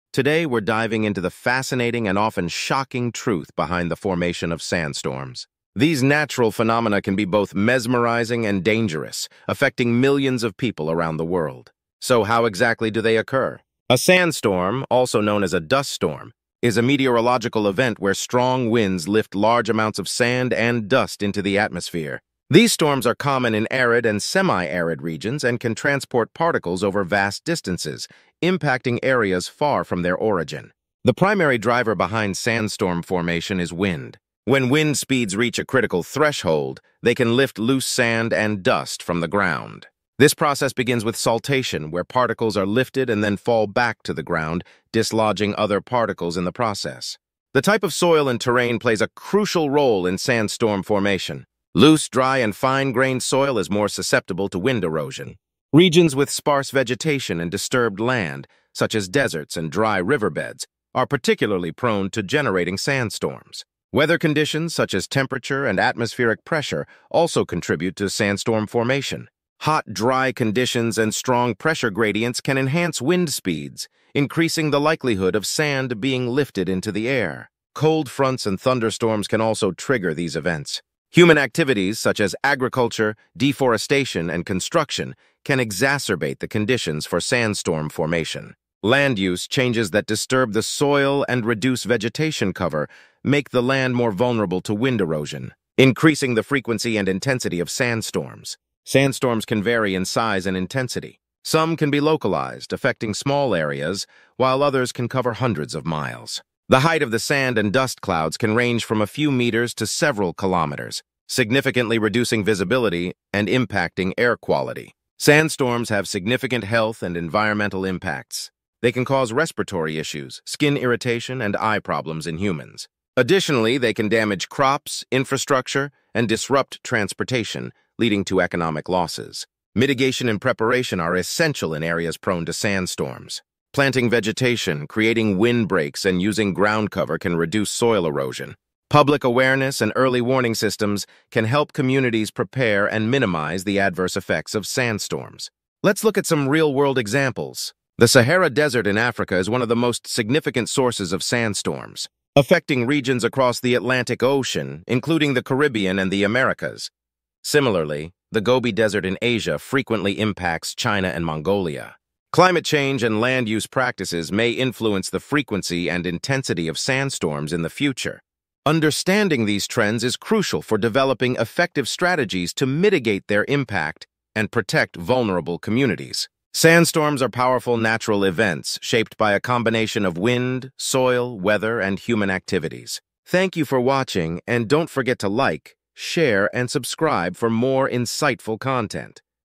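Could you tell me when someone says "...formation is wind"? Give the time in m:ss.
0:33.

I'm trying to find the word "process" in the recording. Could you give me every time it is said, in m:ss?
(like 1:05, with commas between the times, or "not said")
0:40, 0:46.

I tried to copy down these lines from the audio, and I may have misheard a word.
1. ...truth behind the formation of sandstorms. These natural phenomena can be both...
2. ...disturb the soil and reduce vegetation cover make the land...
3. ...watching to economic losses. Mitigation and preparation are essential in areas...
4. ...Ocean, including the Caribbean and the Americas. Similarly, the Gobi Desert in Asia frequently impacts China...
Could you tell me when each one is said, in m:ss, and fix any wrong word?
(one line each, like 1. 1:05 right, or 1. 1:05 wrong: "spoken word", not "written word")
1. 0:03 right
2. 1:30 right
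3. 2:07 wrong: "leading", not "watching"
4. 2:34 right.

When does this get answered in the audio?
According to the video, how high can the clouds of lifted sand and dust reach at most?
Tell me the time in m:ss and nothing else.
1:49.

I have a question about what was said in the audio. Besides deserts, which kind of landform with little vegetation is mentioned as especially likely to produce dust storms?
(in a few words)
Dry riverbeds.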